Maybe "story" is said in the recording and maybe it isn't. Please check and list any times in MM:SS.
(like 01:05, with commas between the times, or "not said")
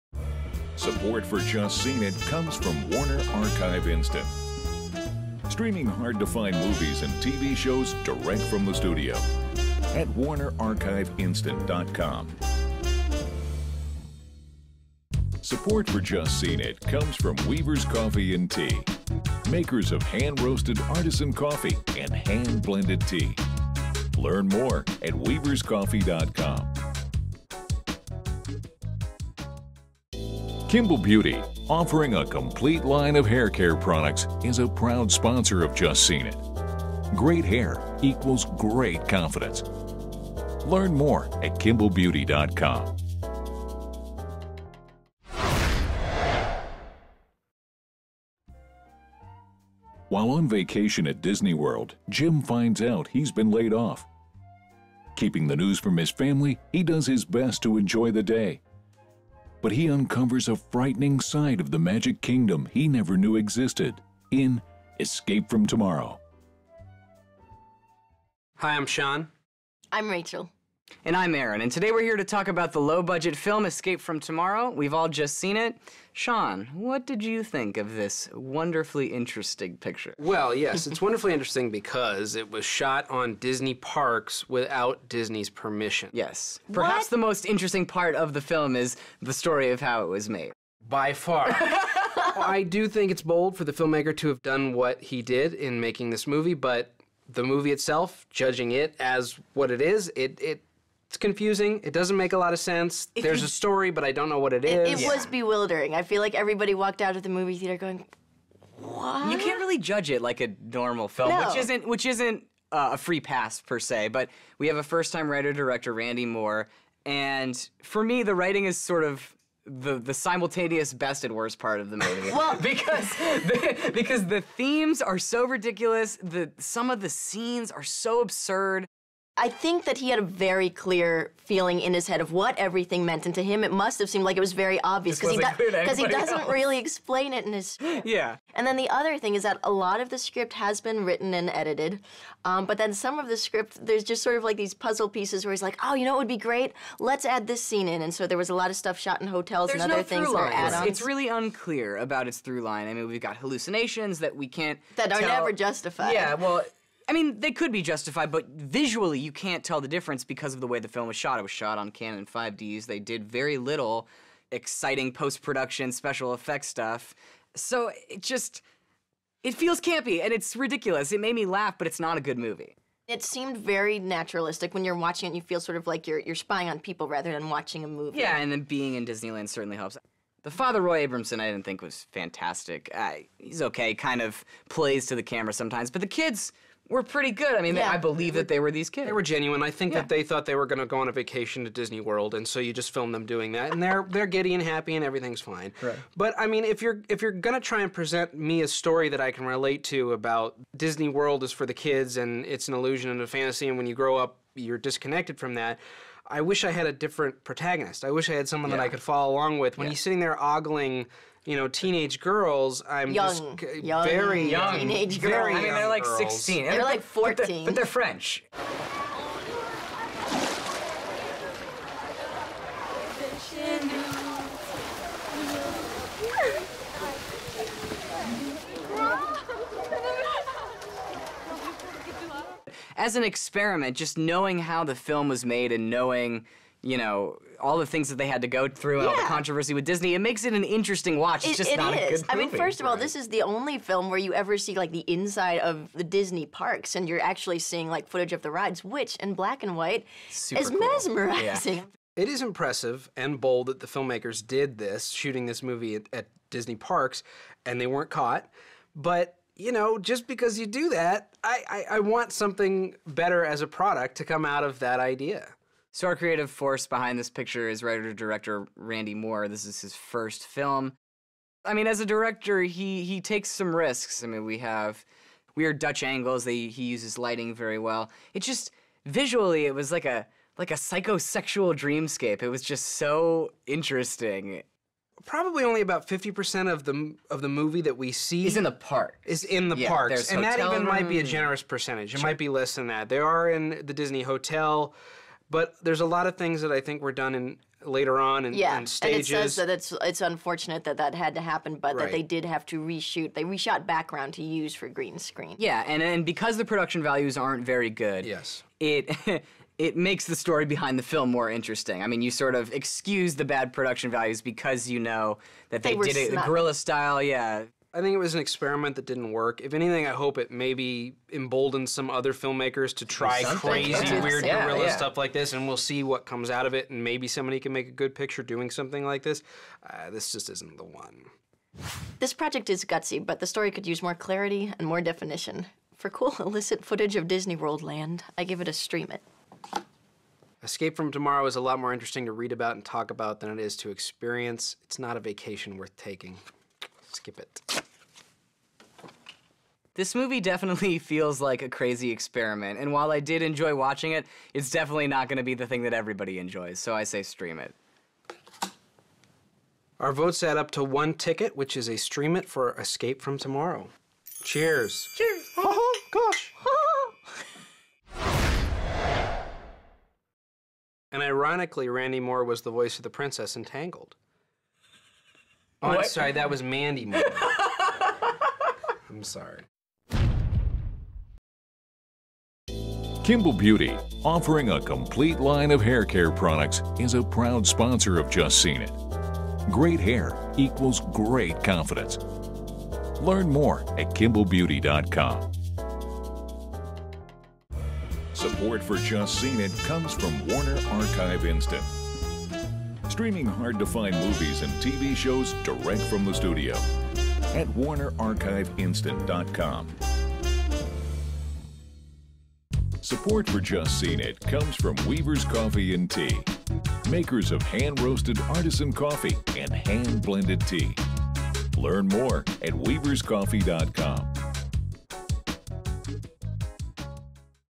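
01:29, 01:43, 03:18, 05:10, 05:33.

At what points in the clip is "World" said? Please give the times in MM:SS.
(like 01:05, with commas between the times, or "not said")
00:51, 03:12, 03:21, 05:37.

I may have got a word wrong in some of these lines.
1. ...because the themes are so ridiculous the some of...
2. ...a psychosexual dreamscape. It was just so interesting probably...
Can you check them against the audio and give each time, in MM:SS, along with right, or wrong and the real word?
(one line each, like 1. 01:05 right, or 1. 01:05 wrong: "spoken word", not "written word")
1. 02:03 right
2. 04:40 right.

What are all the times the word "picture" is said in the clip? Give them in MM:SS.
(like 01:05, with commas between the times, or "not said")
01:19, 04:27, 05:28.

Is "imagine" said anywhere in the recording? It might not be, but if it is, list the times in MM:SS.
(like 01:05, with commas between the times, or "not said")
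not said.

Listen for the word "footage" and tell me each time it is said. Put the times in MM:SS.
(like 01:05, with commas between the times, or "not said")
04:08, 05:36.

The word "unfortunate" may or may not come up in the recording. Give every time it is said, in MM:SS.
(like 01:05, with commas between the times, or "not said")
05:00.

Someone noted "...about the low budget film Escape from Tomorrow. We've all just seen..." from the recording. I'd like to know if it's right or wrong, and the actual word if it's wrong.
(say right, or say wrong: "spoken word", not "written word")
right.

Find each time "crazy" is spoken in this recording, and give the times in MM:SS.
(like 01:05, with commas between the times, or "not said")
05:23, 05:51.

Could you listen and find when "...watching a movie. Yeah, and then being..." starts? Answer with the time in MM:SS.
02:57.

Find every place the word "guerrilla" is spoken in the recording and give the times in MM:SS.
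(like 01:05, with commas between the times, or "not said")
05:16, 05:24.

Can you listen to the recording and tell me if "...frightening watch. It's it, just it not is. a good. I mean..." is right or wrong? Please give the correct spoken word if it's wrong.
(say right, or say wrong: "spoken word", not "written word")
wrong: "interesting", not "frightening".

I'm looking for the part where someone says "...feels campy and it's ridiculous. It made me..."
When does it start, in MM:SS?
02:49.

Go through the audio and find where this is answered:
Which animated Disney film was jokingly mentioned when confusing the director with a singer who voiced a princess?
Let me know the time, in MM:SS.
06:13.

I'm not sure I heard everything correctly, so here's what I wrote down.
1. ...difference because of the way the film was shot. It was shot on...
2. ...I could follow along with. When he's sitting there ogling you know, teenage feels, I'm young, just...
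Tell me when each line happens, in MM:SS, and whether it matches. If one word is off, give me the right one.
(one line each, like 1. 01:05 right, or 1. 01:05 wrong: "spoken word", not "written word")
1. 02:39 right
2. 03:28 wrong: "girls", not "feels".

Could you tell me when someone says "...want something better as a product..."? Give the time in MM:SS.
04:22.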